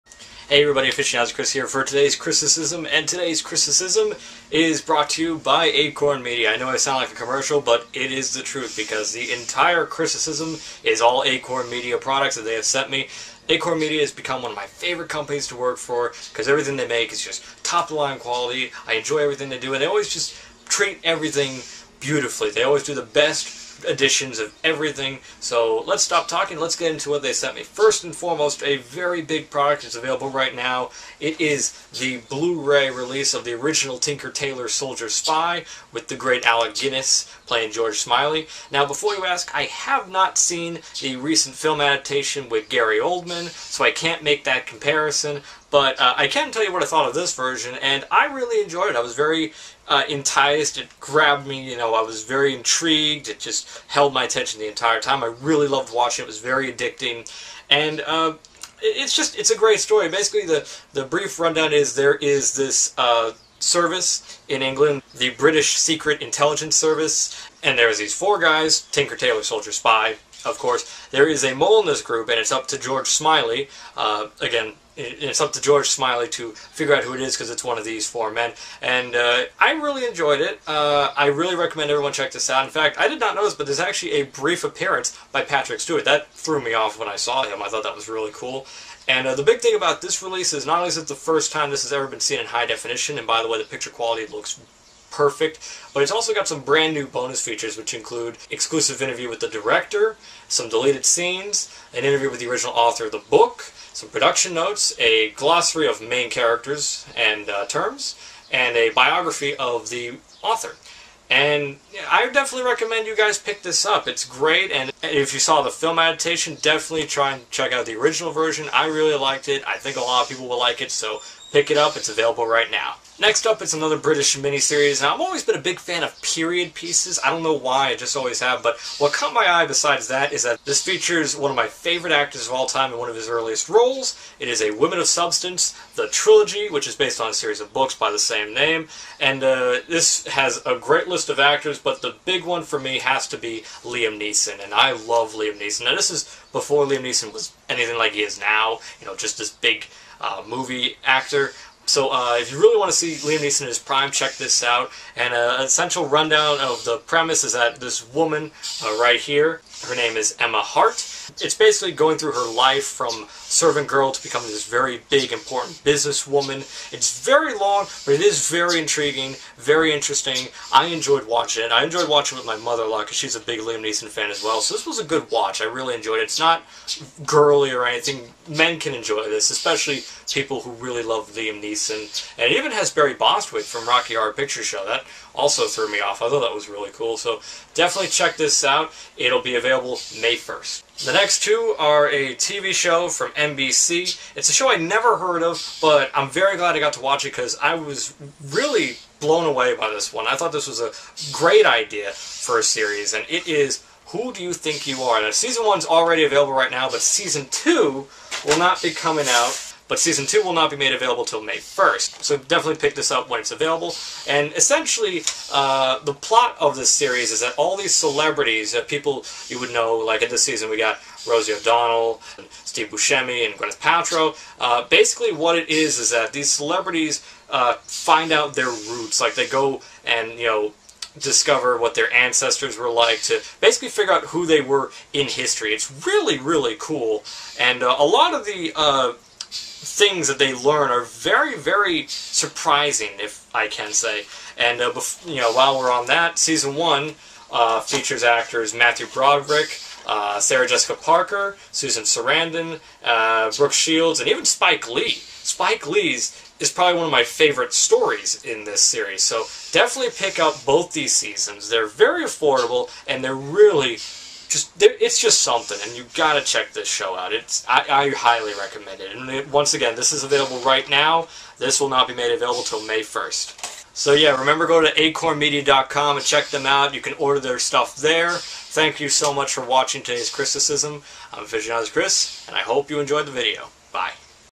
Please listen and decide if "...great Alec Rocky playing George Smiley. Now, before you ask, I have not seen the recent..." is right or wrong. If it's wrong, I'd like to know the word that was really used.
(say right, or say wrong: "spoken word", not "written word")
wrong: "Guinness", not "Rocky".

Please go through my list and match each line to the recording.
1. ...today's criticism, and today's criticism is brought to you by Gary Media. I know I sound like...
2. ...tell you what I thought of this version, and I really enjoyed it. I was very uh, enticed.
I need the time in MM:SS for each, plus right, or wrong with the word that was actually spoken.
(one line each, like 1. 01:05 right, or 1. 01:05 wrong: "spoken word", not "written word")
1. 00:01 wrong: "Acorn", not "Gary"
2. 00:46 right.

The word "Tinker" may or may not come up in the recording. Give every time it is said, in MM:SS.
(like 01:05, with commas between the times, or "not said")
00:33, 01:08.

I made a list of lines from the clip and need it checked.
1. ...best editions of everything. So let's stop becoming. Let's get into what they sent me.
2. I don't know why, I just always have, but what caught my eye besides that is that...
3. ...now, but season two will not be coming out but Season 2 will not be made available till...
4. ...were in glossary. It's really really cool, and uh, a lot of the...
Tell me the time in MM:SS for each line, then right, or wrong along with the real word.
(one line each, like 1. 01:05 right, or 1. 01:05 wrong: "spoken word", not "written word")
1. 00:23 wrong: "talking", not "becoming"
2. 02:07 right
3. 03:26 right
4. 03:54 wrong: "history", not "glossary".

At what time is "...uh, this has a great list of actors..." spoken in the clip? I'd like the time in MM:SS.
02:19.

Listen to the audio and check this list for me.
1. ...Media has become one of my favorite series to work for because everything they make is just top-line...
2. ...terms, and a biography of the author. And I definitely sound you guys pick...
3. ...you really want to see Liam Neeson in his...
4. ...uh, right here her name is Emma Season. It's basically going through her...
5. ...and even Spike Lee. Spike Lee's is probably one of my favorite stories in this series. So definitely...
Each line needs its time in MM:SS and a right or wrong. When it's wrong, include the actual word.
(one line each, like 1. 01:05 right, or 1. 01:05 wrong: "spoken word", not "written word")
1. 00:13 wrong: "companies", not "series"
2. 01:47 wrong: "recommend", not "sound"
3. 02:32 right
4. 02:38 wrong: "Hart", not "Season"
5. 04:14 right.